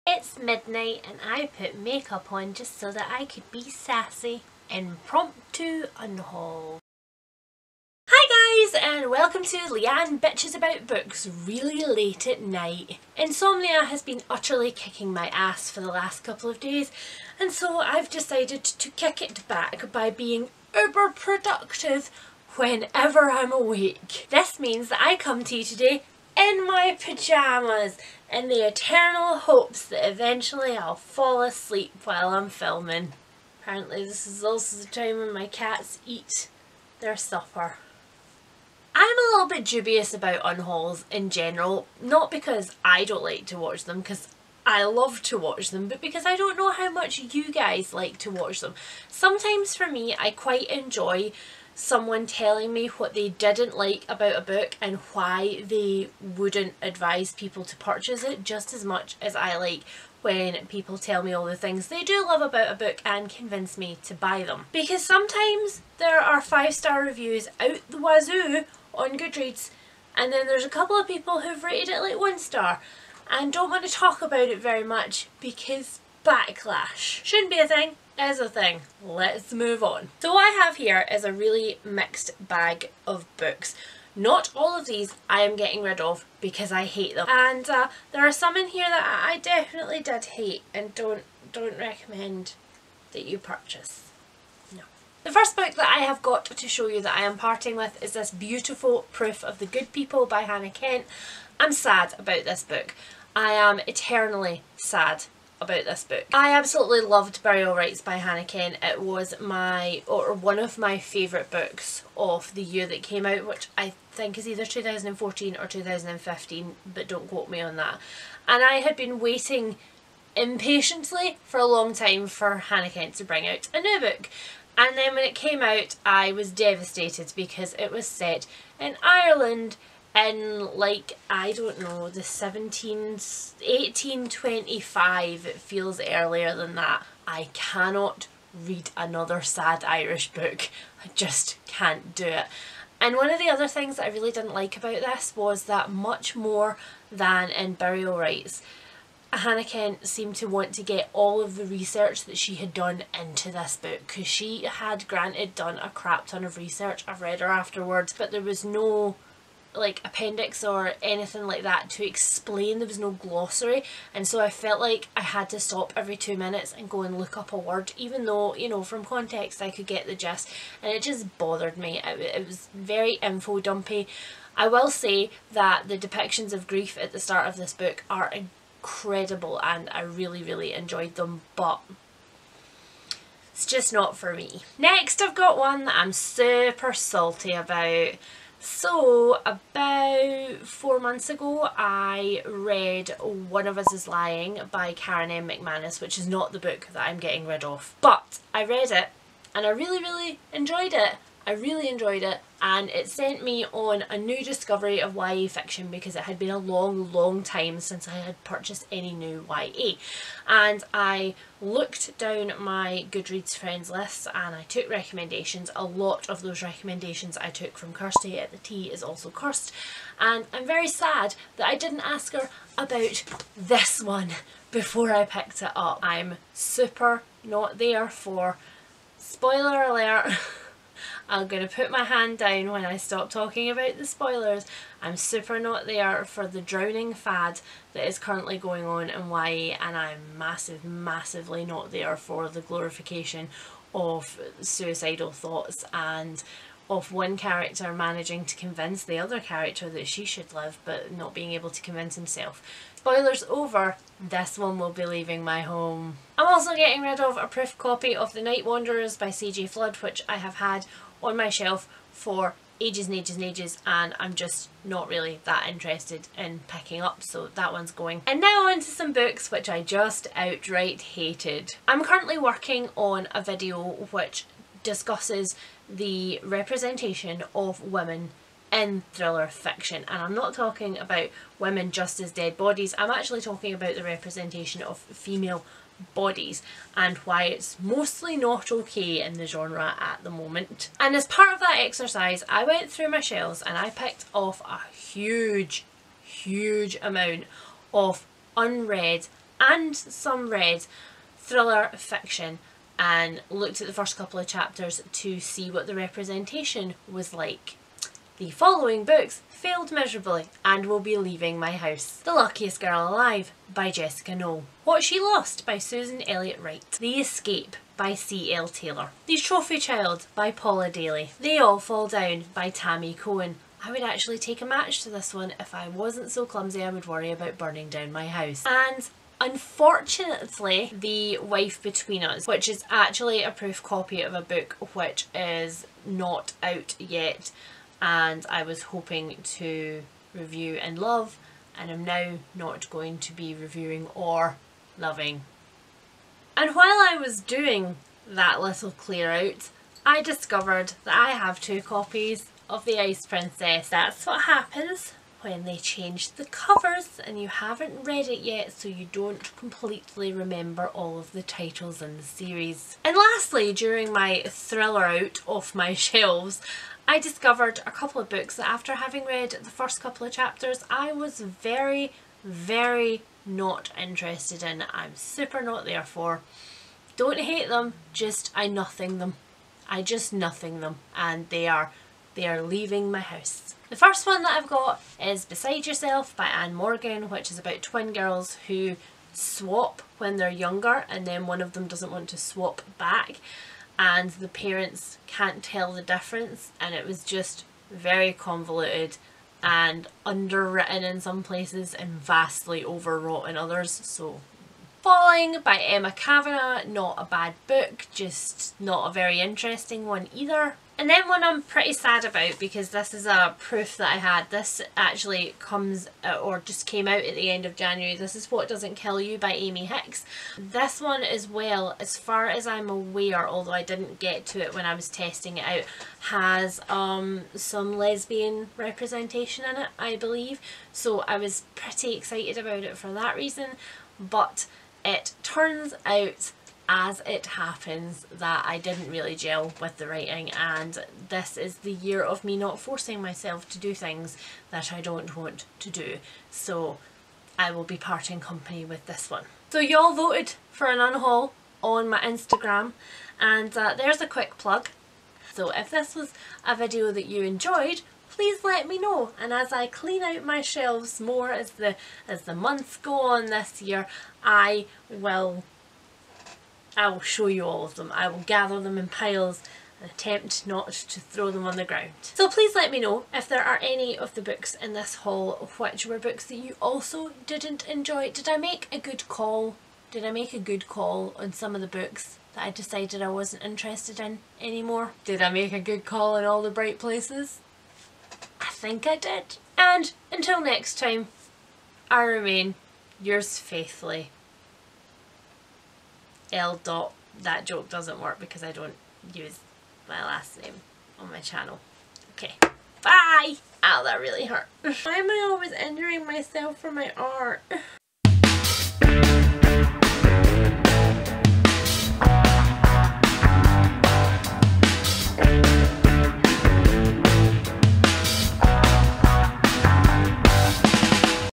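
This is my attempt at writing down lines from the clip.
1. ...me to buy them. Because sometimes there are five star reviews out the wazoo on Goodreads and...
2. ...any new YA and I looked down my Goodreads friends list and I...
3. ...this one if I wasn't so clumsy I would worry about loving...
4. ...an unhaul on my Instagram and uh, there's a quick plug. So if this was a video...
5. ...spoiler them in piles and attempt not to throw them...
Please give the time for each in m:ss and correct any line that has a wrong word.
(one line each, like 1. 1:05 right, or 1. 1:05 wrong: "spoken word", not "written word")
1. 1:03 right
2. 3:28 right
3. 5:25 wrong: "burning", not "loving"
4. 7:30 right
5. 7:48 wrong: "gather", not "spoiler".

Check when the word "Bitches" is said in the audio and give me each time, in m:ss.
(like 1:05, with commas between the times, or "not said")
0:10.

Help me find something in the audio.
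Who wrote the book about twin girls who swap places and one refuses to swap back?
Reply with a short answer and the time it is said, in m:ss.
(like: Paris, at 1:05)
Ann Morgan, at 6:26.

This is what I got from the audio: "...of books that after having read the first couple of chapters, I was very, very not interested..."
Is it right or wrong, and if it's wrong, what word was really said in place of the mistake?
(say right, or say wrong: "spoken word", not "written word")
right.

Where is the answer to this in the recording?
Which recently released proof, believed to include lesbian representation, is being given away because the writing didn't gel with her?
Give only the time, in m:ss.
6:58.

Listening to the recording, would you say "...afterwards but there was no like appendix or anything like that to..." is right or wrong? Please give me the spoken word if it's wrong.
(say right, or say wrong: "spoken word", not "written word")
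right.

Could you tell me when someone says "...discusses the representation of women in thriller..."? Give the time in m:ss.
4:34.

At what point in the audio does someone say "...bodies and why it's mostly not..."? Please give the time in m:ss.
4:46.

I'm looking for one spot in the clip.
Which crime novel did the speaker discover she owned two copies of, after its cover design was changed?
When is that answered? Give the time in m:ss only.
5:52.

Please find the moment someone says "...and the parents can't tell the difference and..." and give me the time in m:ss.
6:33.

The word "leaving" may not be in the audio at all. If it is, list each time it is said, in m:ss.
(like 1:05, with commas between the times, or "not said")
4:15, 5:11, 6:22.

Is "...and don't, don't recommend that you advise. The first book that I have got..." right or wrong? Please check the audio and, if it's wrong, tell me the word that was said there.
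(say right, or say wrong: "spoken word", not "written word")
wrong: "purchase", not "advise".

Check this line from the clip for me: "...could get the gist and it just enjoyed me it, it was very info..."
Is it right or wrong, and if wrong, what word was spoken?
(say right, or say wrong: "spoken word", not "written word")
wrong: "bothered", not "enjoyed".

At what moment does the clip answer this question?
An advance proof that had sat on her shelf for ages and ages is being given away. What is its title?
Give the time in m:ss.
4:18.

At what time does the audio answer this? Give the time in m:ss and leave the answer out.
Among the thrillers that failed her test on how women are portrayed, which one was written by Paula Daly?
5:19.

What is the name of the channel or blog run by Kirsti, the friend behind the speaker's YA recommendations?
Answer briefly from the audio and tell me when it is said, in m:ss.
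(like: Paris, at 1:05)
The Tea Is Also Cursed, at 3:38.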